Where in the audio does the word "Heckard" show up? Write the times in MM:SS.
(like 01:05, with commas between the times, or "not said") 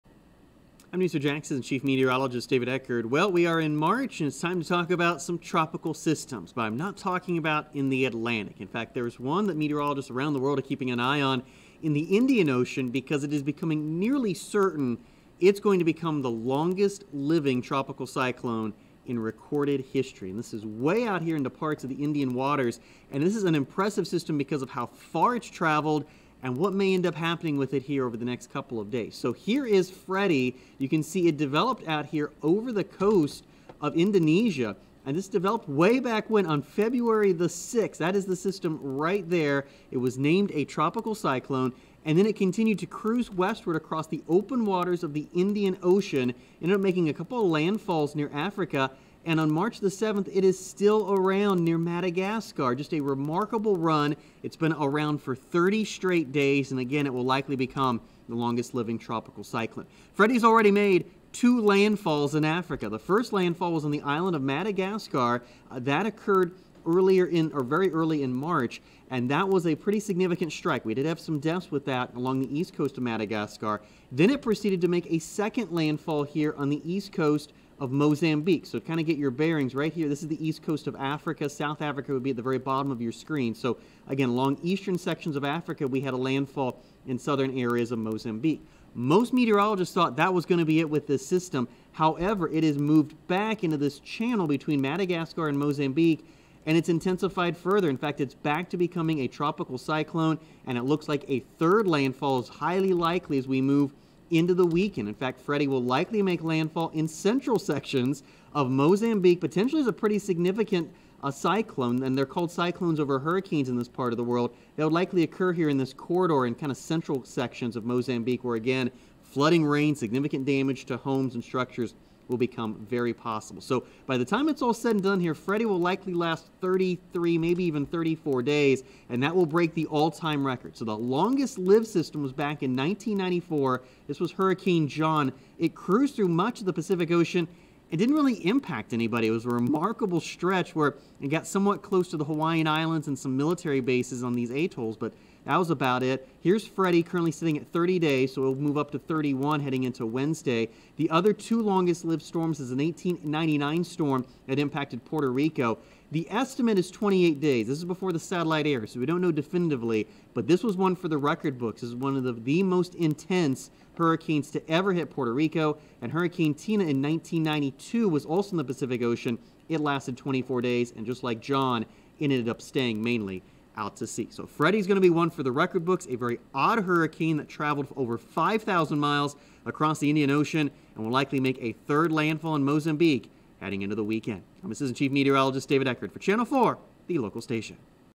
00:02, 03:05.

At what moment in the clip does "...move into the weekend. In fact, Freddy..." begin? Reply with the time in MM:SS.
01:43.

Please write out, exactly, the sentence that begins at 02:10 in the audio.
So the longest lived system was back in 1994.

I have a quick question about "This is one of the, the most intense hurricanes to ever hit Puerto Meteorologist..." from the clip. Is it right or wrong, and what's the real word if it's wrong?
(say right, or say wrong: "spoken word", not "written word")
wrong: "Rico", not "Meteorologist".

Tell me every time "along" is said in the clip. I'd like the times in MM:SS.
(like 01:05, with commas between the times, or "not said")
01:12, 01:24.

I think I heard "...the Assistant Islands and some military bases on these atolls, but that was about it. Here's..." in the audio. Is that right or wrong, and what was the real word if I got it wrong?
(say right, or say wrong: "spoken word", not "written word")
wrong: "Hawaiian", not "Assistant".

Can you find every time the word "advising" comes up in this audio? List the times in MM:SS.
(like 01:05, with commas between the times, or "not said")
not said.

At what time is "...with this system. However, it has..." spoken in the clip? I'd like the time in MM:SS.
01:30.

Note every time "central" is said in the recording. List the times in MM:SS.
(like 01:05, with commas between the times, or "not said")
01:47, 01:56.